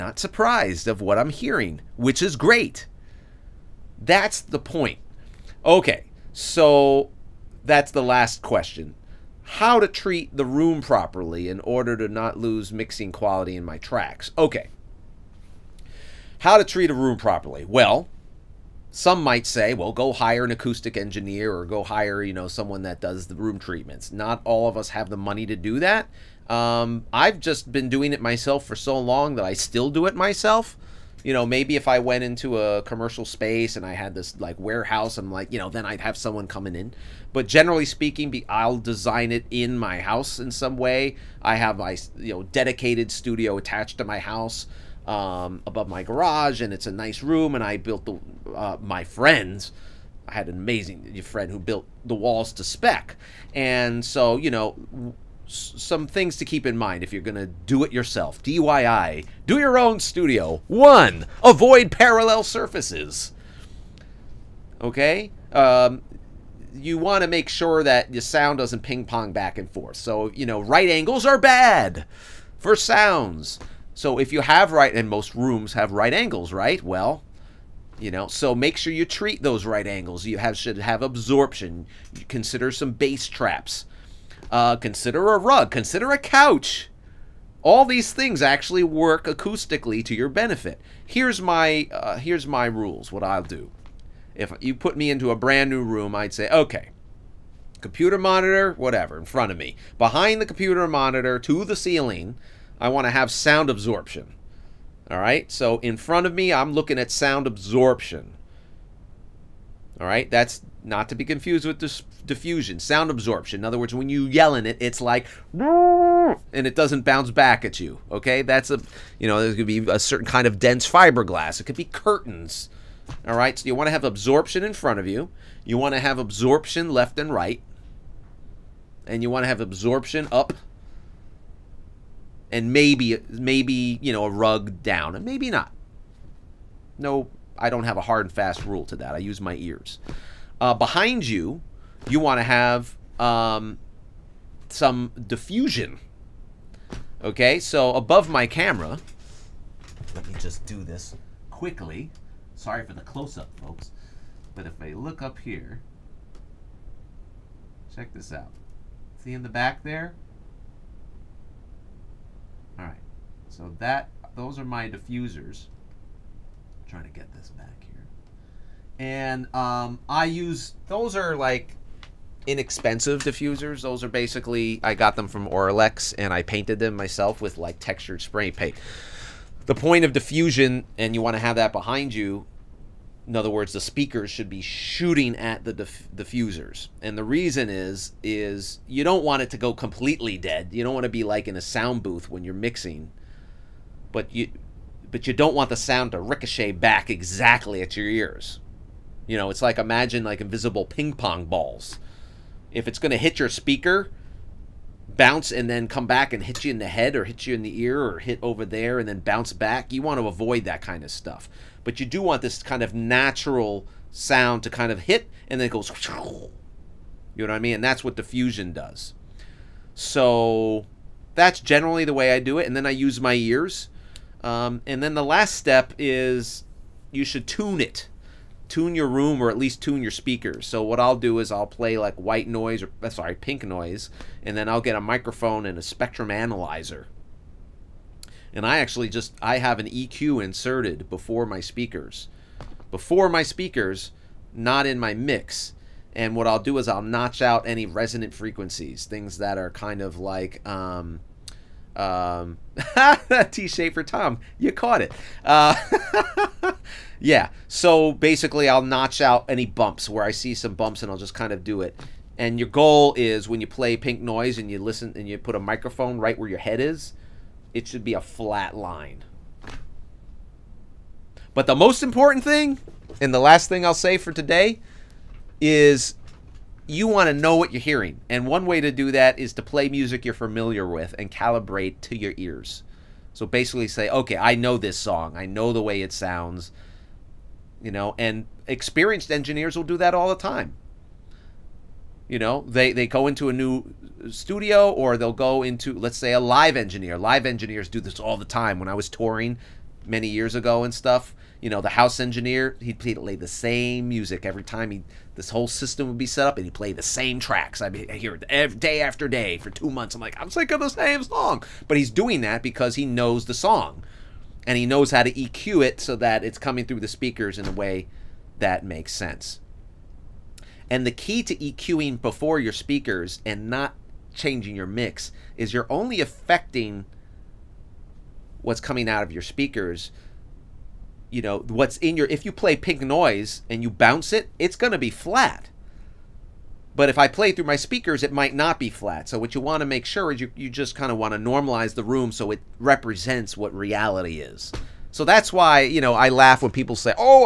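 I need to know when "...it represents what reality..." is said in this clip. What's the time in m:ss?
5:42.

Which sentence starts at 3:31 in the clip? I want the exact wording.
But you do want this kind of natural sound to kind of hit and then it goes.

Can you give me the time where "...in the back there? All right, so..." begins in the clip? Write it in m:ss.
2:39.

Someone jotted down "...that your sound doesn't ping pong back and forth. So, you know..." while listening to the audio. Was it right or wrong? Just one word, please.
right.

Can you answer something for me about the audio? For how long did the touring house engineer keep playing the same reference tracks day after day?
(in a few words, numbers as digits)
2 months.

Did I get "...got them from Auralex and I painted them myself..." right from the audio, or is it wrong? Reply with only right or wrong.
right.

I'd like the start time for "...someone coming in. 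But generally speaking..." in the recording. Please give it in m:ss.
0:36.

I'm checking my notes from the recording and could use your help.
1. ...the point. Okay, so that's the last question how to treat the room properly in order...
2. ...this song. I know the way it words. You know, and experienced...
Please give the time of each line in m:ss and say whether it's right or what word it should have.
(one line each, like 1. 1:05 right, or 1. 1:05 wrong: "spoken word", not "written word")
1. 0:04 right
2. 4:44 wrong: "sounds", not "words".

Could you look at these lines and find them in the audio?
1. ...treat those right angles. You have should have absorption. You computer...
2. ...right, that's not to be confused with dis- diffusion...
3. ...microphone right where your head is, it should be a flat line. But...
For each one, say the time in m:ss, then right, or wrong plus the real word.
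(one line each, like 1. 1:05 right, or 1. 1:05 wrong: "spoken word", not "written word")
1. 1:19 wrong: "consider", not "computer"
2. 1:50 right
3. 4:25 right.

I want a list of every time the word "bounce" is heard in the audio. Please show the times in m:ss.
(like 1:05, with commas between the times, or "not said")
1:57, 3:25, 3:29, 5:33.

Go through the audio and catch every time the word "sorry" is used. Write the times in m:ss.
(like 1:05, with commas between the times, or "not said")
2:32, 3:53.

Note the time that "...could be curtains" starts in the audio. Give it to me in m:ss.
2:01.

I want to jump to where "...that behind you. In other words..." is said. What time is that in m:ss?
3:01.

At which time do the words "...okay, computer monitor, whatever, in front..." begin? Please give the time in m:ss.
1:36.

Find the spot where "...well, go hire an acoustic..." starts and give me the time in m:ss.
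0:19.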